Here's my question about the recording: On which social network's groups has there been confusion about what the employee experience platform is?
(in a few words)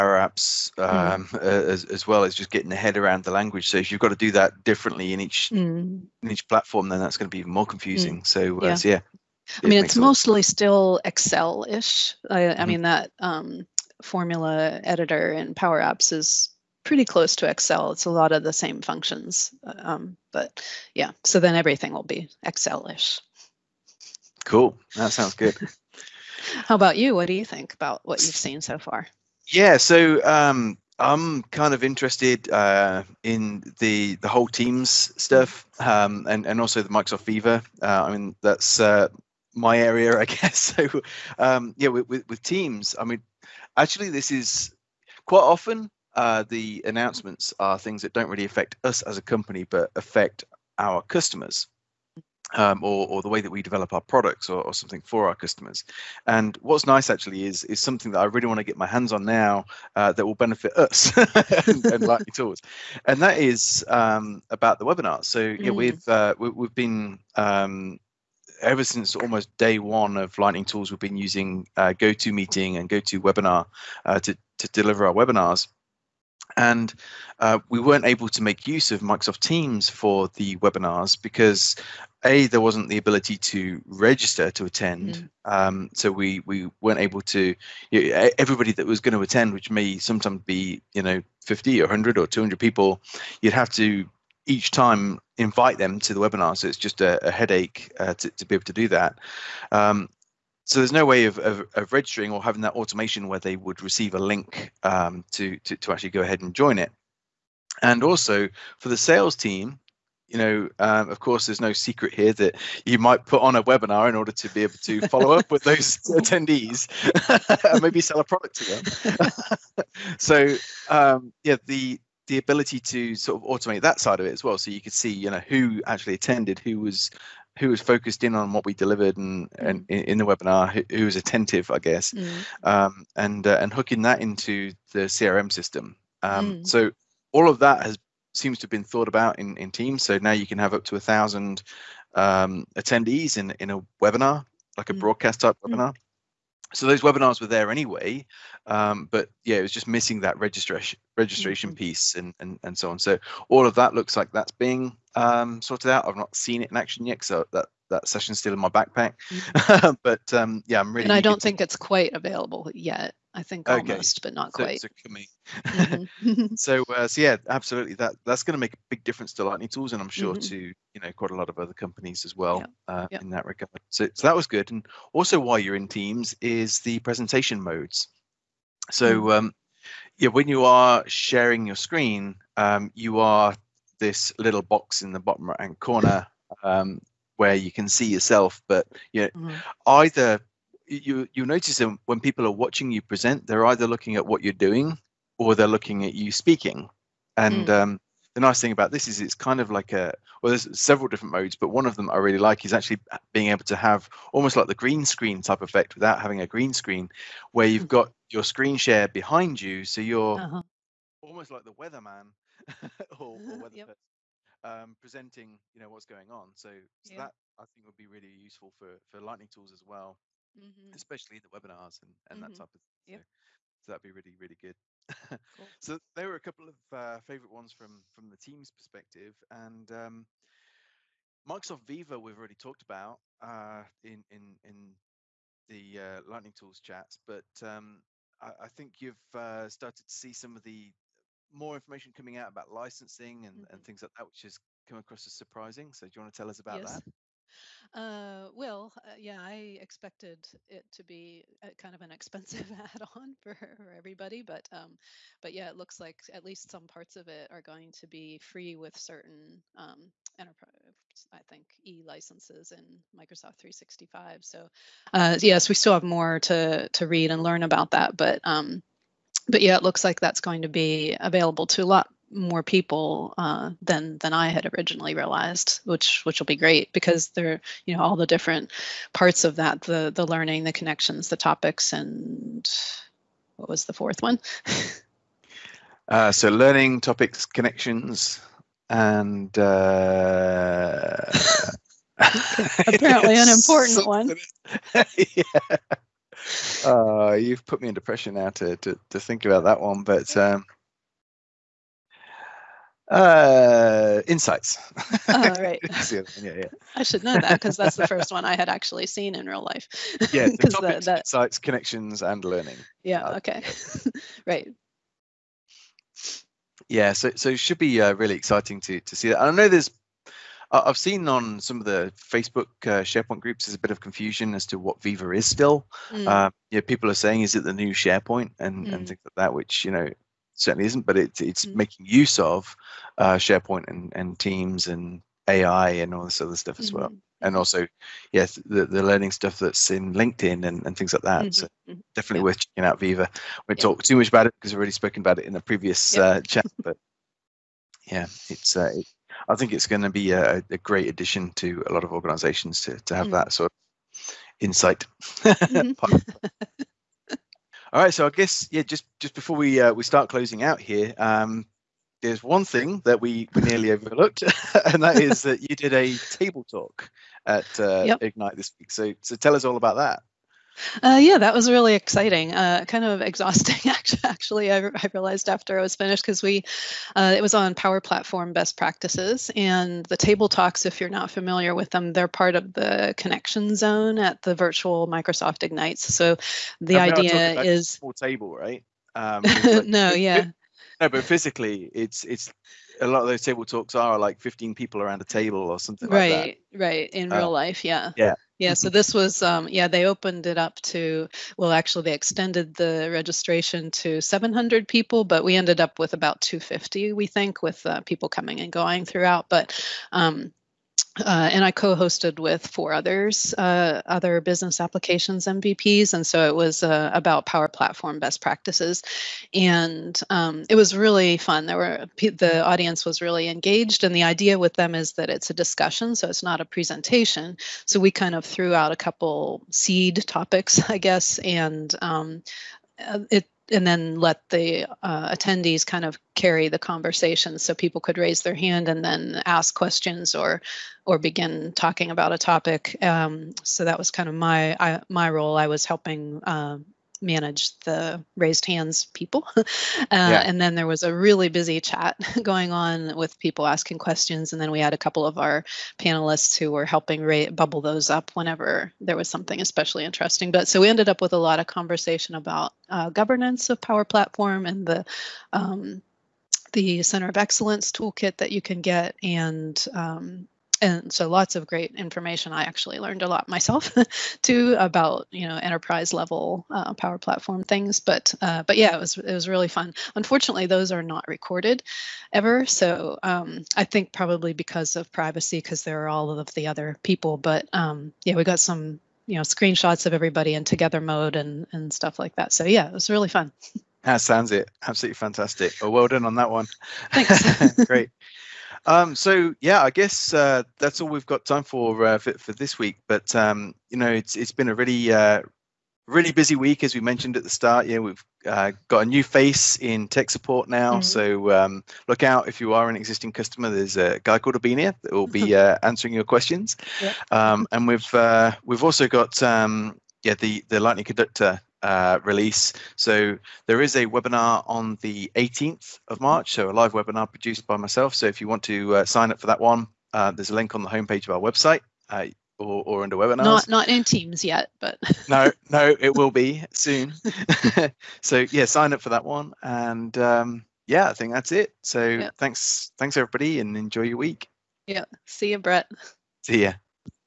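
Facebook.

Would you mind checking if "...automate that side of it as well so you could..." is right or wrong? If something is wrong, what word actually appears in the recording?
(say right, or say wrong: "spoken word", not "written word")
right.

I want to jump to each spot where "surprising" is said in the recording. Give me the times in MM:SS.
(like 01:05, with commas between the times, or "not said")
04:05.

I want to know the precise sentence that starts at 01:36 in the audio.
So it's just a, a headache uh, to, to, be able to do that.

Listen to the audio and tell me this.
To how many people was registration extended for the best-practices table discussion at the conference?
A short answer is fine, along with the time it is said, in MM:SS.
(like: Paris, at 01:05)
700, at 06:44.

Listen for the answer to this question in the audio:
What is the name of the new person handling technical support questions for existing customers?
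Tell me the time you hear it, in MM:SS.
08:34.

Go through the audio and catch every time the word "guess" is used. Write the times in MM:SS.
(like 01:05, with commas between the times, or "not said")
00:40, 02:11, 05:58, 07:10, 08:19.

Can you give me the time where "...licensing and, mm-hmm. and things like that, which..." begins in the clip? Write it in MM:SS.
04:02.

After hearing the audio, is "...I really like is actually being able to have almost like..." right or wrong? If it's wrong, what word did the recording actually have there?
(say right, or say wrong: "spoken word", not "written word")
right.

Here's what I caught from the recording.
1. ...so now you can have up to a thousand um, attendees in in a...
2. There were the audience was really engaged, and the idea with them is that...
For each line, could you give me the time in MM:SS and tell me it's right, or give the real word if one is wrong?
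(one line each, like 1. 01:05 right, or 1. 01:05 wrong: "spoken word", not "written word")
1. 02:20 right
2. 07:01 right.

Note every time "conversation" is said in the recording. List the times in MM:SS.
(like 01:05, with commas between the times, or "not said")
07:16, 07:41.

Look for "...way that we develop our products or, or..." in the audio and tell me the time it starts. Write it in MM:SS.
00:53.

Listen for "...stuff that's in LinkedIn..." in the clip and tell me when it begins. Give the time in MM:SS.
05:39.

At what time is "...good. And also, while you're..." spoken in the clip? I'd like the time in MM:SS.
02:54.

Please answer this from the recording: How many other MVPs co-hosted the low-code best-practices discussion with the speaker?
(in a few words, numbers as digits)
four.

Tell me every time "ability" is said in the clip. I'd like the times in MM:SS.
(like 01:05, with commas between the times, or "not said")
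01:22, 02:02.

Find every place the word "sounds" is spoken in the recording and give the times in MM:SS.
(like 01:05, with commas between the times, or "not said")
00:25, 08:14.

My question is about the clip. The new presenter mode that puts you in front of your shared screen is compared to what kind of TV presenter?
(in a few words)
weatherman.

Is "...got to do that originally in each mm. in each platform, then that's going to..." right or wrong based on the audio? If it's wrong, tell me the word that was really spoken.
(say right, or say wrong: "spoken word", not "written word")
wrong: "differently", not "originally".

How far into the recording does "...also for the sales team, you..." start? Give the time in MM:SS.
01:48.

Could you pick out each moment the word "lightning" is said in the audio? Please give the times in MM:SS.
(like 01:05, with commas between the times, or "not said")
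01:10, 02:49, 03:39, 03:56, 08:40.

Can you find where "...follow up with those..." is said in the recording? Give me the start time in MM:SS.
01:55.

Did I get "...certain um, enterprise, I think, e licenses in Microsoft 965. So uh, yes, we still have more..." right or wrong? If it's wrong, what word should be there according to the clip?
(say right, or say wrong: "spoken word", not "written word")
wrong: "365", not "965".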